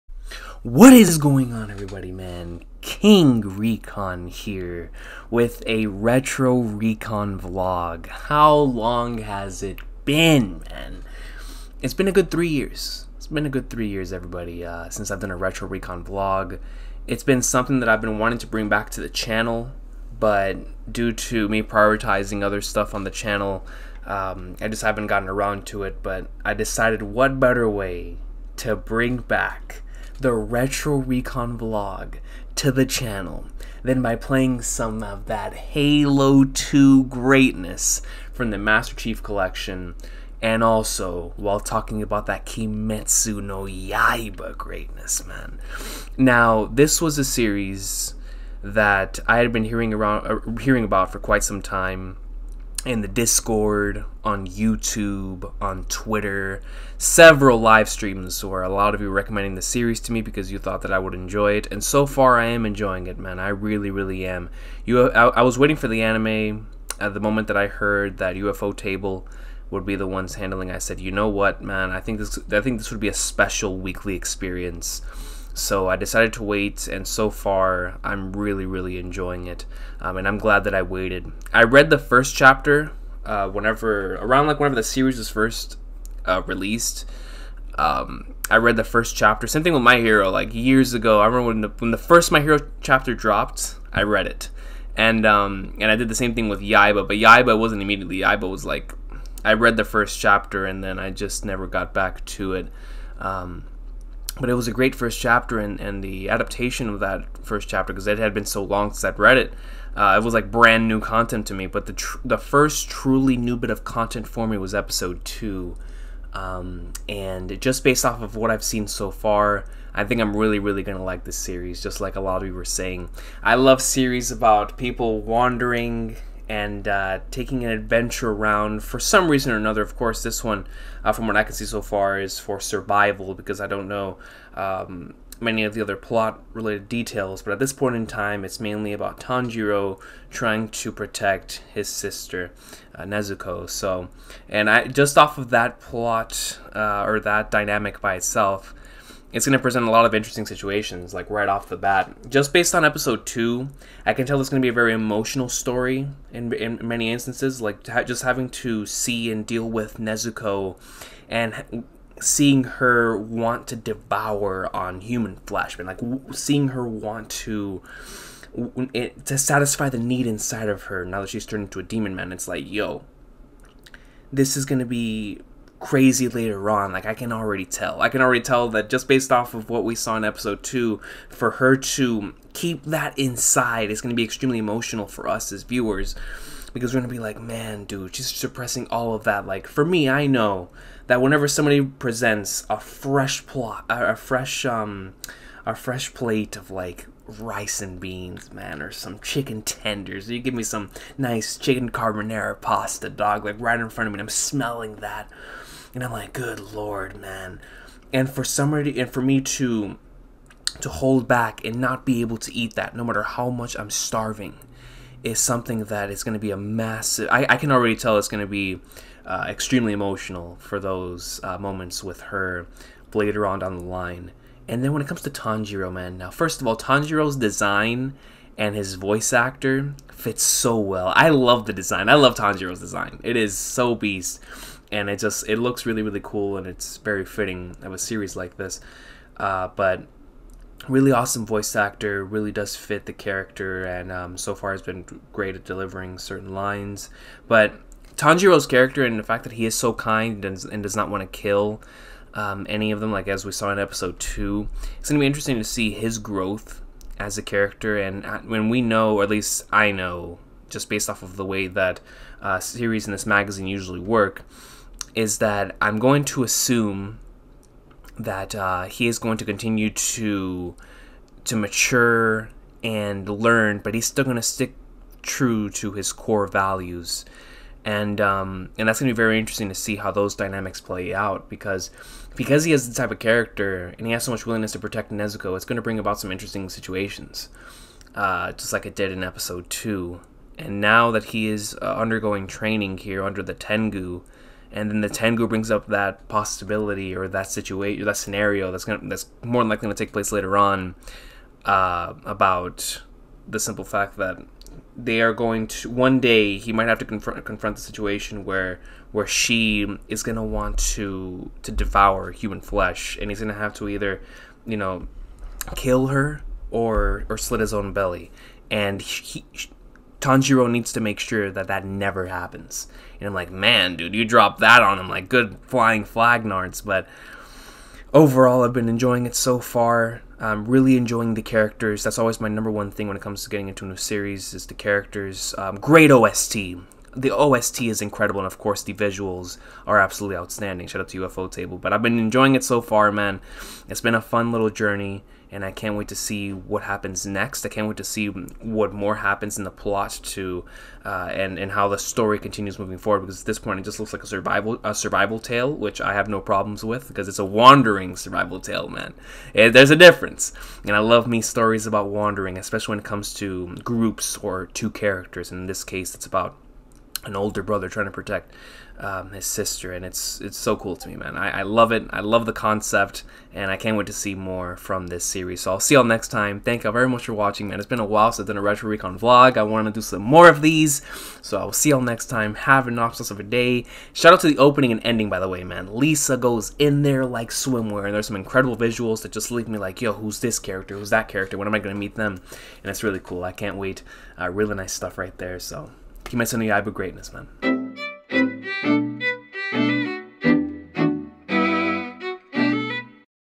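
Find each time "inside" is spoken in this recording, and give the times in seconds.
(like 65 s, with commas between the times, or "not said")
170 s, 183 s.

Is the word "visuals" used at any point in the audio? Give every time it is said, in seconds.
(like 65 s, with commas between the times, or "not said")
338 s, 388 s.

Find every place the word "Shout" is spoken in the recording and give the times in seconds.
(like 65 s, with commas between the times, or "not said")
340 s, 384 s.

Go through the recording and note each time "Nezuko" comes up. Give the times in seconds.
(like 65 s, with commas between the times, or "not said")
143 s, 159 s, 285 s.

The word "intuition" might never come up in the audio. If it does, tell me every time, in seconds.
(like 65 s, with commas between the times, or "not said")
not said.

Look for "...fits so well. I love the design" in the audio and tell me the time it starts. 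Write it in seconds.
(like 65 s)
230 s.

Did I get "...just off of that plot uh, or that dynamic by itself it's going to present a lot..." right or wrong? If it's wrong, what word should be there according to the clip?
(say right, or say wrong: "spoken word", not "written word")
right.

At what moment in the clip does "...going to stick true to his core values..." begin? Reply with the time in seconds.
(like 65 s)
274 s.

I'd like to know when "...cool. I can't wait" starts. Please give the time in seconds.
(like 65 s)
393 s.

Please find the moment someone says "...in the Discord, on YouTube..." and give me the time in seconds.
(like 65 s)
52 s.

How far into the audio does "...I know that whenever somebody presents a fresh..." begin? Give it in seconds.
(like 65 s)
190 s.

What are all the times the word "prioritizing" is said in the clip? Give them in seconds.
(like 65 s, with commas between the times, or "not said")
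21 s.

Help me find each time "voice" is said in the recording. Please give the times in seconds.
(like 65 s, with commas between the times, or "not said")
228 s, 241 s.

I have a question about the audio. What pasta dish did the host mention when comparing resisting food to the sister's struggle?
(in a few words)
Chicken carbonara pasta.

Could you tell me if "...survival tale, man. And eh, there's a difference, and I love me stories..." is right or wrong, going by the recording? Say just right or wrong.
right.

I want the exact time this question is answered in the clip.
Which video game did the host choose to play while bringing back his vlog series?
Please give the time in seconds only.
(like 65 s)
35 s.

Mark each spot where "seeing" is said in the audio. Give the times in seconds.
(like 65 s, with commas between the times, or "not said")
162 s, 166 s.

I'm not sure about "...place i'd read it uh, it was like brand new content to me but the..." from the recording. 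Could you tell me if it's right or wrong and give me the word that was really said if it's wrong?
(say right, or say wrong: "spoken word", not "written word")
wrong: "since", not "place".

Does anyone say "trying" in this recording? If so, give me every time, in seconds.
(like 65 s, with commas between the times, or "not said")
140 s, 367 s.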